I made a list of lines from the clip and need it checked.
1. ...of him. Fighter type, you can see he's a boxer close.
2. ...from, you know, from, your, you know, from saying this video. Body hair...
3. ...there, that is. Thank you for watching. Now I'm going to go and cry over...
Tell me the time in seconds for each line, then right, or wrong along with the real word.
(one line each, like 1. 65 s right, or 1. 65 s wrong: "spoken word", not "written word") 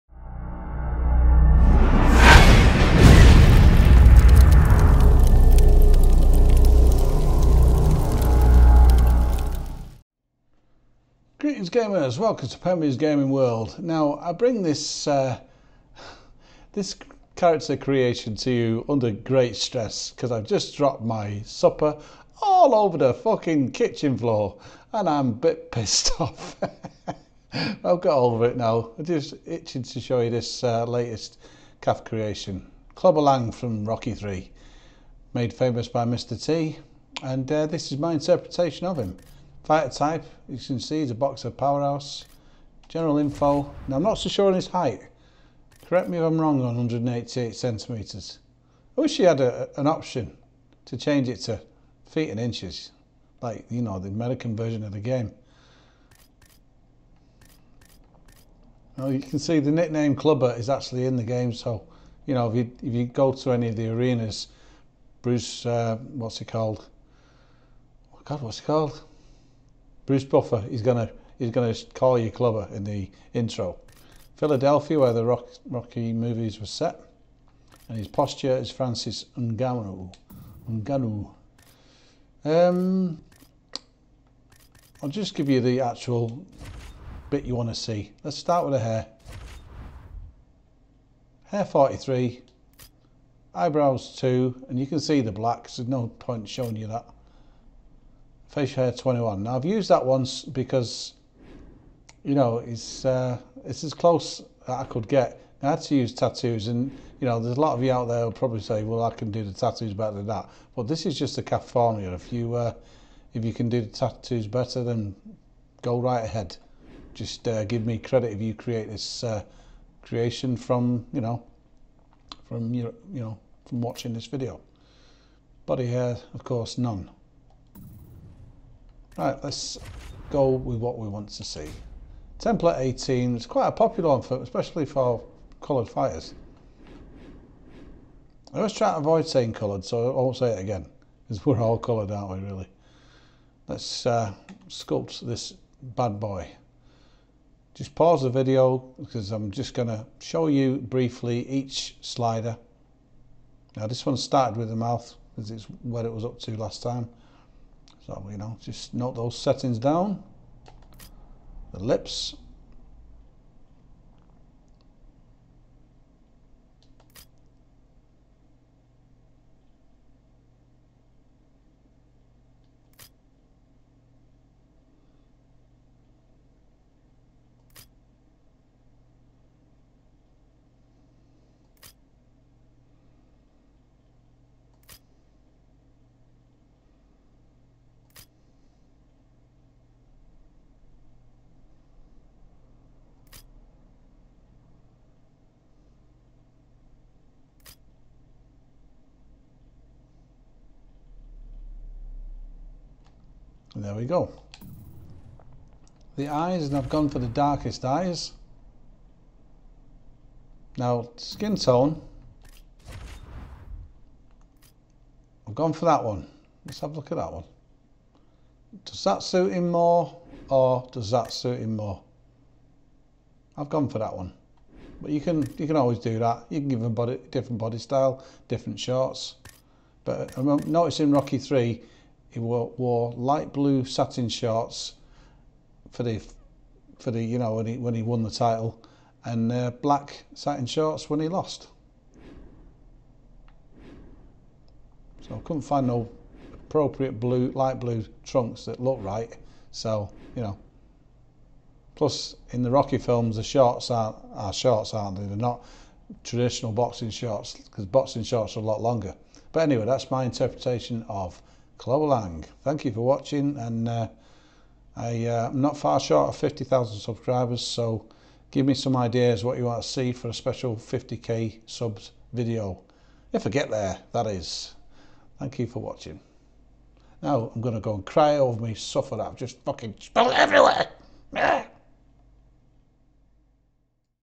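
1. 38 s wrong: "powerhouse", not "close"
2. 120 s wrong: "watching", not "saying"
3. 273 s right.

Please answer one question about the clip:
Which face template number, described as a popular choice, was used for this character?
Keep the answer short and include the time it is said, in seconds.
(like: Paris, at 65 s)
18, at 132 s.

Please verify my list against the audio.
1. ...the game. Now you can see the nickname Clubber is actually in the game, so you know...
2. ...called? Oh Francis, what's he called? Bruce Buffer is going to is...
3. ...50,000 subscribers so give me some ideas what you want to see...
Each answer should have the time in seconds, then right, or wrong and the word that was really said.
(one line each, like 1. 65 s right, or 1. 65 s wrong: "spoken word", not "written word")
1. 54 s right
2. 66 s wrong: "God", not "Francis"
3. 266 s right.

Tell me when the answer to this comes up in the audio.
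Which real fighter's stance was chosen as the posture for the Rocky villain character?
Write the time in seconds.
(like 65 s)
78 s.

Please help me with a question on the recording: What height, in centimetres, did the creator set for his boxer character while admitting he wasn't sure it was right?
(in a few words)
188 centimetres.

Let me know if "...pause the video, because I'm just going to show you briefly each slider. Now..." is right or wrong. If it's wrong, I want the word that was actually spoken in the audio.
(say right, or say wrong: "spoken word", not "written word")
right.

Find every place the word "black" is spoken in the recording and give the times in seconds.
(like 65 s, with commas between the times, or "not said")
95 s, 239 s.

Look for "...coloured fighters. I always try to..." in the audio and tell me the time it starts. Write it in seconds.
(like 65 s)
135 s.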